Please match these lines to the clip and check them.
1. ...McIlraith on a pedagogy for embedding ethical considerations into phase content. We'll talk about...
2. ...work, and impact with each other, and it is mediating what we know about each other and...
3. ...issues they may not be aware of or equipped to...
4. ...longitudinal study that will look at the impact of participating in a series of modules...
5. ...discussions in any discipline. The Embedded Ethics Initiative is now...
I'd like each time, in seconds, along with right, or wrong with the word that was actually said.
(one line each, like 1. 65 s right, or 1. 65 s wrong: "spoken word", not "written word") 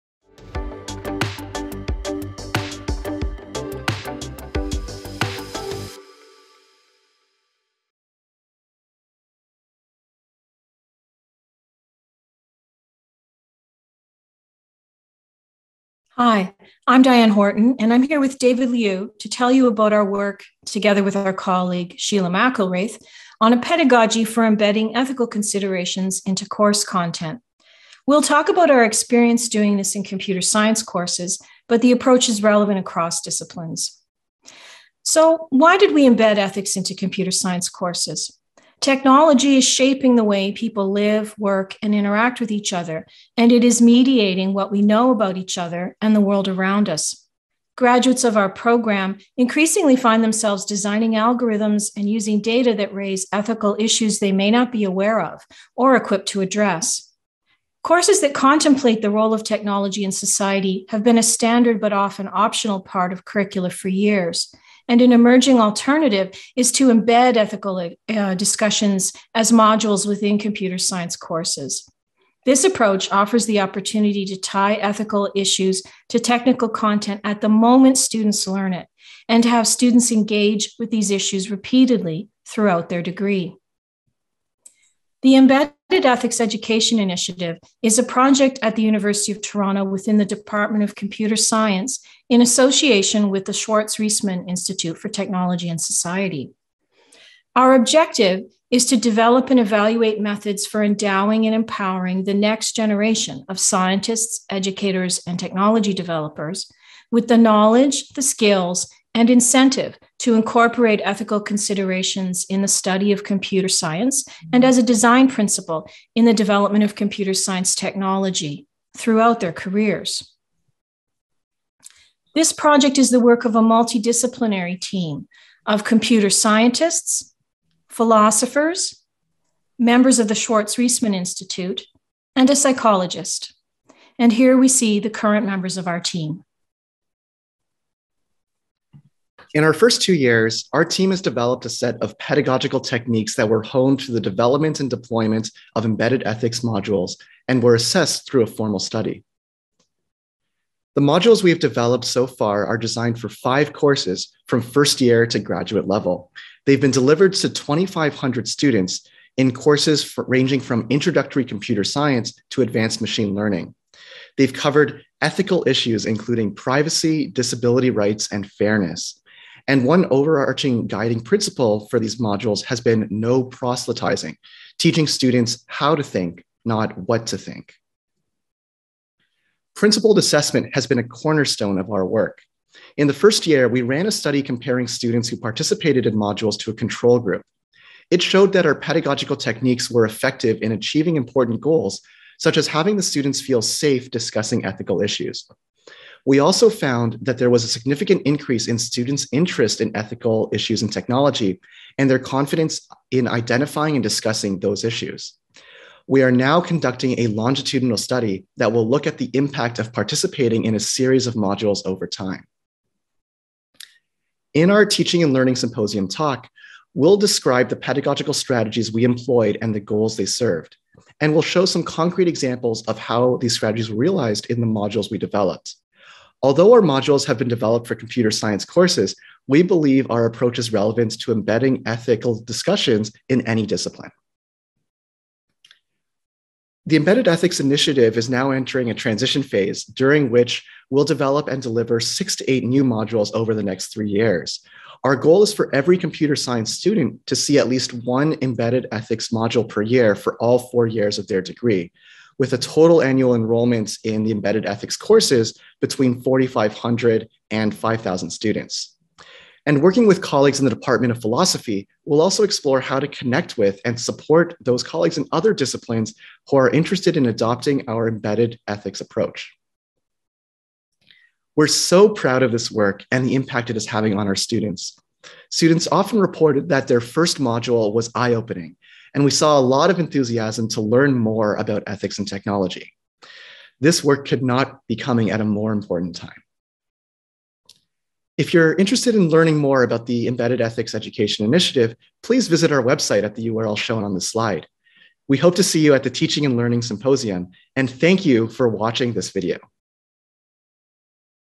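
1. 22 s wrong: "course", not "phase"
2. 41 s wrong: "interact", not "impact"
3. 53 s right
4. 207 s right
5. 232 s right.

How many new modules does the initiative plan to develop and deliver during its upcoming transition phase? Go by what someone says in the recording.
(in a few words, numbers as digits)
6 to 8.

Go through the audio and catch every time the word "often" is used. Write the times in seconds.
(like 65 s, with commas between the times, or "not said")
61 s, 275 s.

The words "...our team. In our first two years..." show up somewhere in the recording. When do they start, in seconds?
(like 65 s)
135 s.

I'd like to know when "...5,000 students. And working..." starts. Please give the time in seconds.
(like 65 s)
257 s.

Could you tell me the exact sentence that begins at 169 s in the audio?
And one overarching guiding principle for these modules has been no proselytizing, teaching students how to think, not what to think.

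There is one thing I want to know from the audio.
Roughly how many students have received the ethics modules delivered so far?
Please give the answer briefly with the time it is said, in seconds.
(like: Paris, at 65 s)
2,500, at 157 s.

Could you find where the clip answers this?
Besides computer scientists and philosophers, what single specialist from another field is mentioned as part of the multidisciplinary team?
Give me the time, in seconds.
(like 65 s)
132 s.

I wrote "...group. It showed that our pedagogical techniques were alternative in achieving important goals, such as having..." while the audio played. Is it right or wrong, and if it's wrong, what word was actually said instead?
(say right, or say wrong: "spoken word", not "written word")
wrong: "effective", not "alternative".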